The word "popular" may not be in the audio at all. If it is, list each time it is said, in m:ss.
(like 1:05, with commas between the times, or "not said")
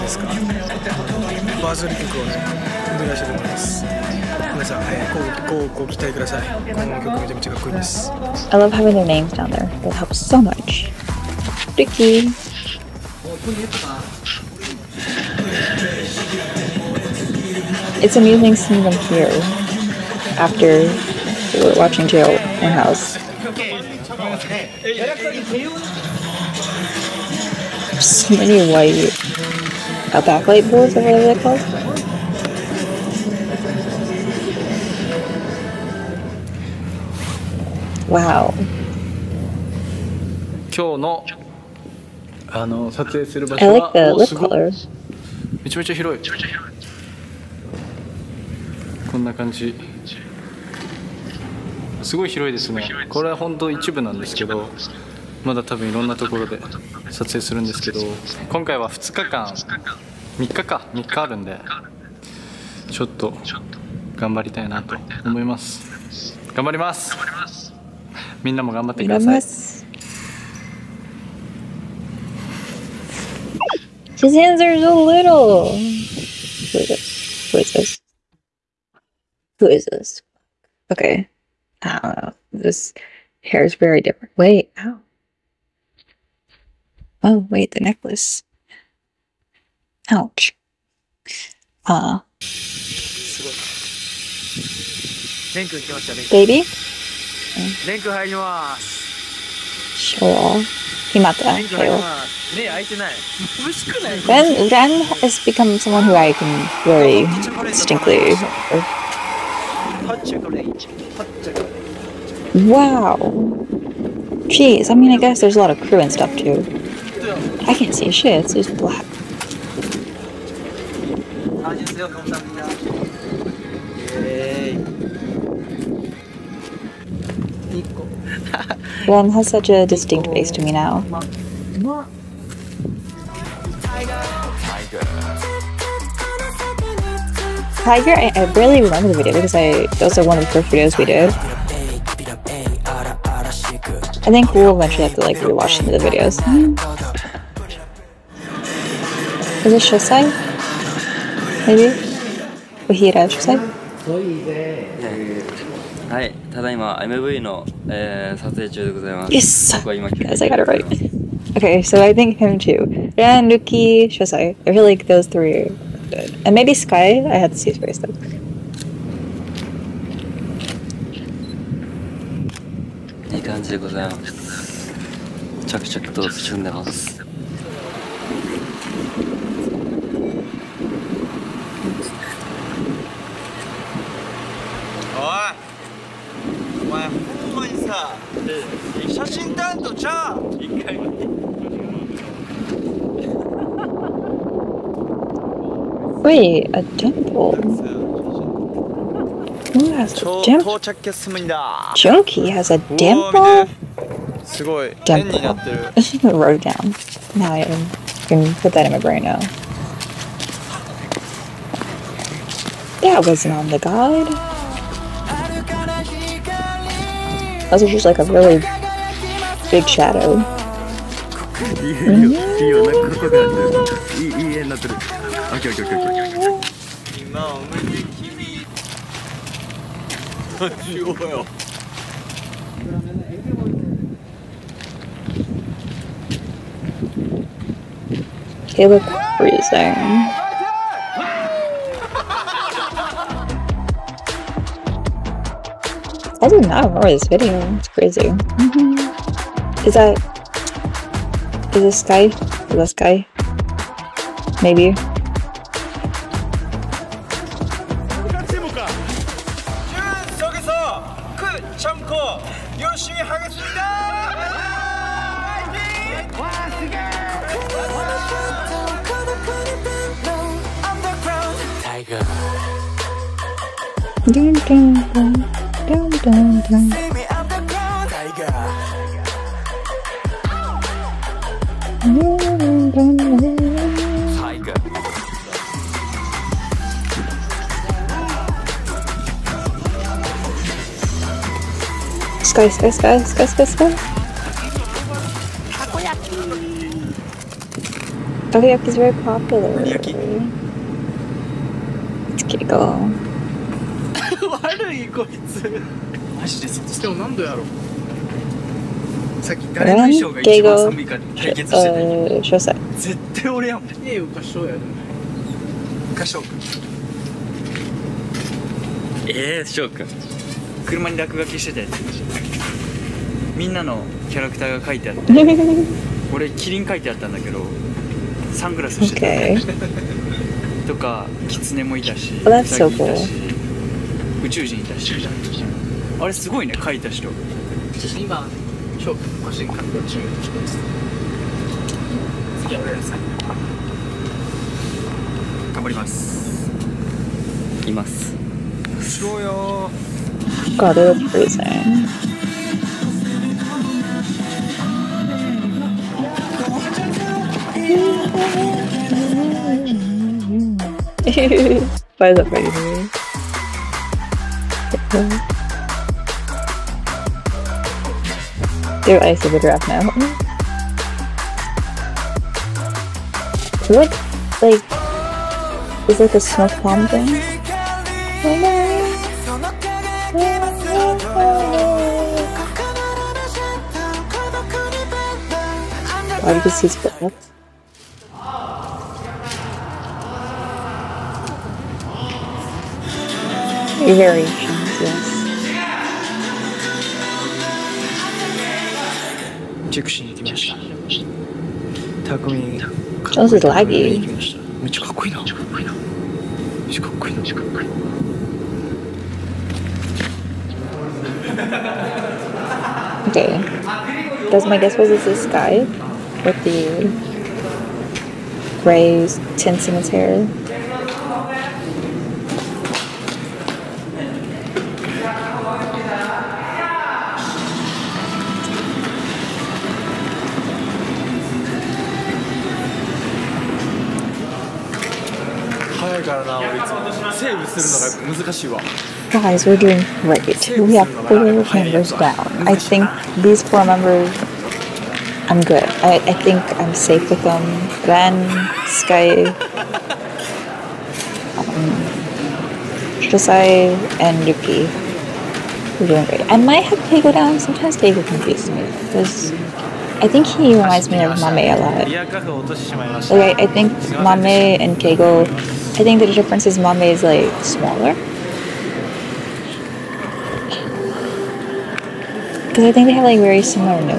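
4:59.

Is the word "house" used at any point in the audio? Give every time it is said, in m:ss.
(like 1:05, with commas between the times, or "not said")
0:22.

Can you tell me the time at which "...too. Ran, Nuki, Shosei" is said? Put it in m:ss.
2:42.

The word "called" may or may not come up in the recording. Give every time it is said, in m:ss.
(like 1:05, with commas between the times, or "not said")
0:31.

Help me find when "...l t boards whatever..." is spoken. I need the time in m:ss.
0:30.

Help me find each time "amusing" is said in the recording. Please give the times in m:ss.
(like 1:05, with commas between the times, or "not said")
0:18.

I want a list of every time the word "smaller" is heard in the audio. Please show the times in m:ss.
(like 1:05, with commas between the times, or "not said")
7:47.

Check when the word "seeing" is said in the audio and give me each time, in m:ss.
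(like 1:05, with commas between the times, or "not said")
0:18.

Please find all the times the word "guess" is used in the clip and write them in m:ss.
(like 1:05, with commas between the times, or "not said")
1:55, 6:54.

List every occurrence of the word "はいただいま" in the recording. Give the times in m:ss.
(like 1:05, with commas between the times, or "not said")
2:36.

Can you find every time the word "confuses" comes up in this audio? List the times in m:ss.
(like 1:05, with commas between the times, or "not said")
7:38.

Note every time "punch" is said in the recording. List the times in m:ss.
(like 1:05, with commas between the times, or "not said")
not said.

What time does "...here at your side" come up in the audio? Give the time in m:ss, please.
2:32.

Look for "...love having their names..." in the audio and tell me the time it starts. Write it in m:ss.
0:08.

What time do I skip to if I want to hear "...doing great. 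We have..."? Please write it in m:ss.
7:19.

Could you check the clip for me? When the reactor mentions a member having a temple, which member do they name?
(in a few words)
Junkie.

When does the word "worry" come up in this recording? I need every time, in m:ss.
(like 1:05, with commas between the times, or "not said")
1:46.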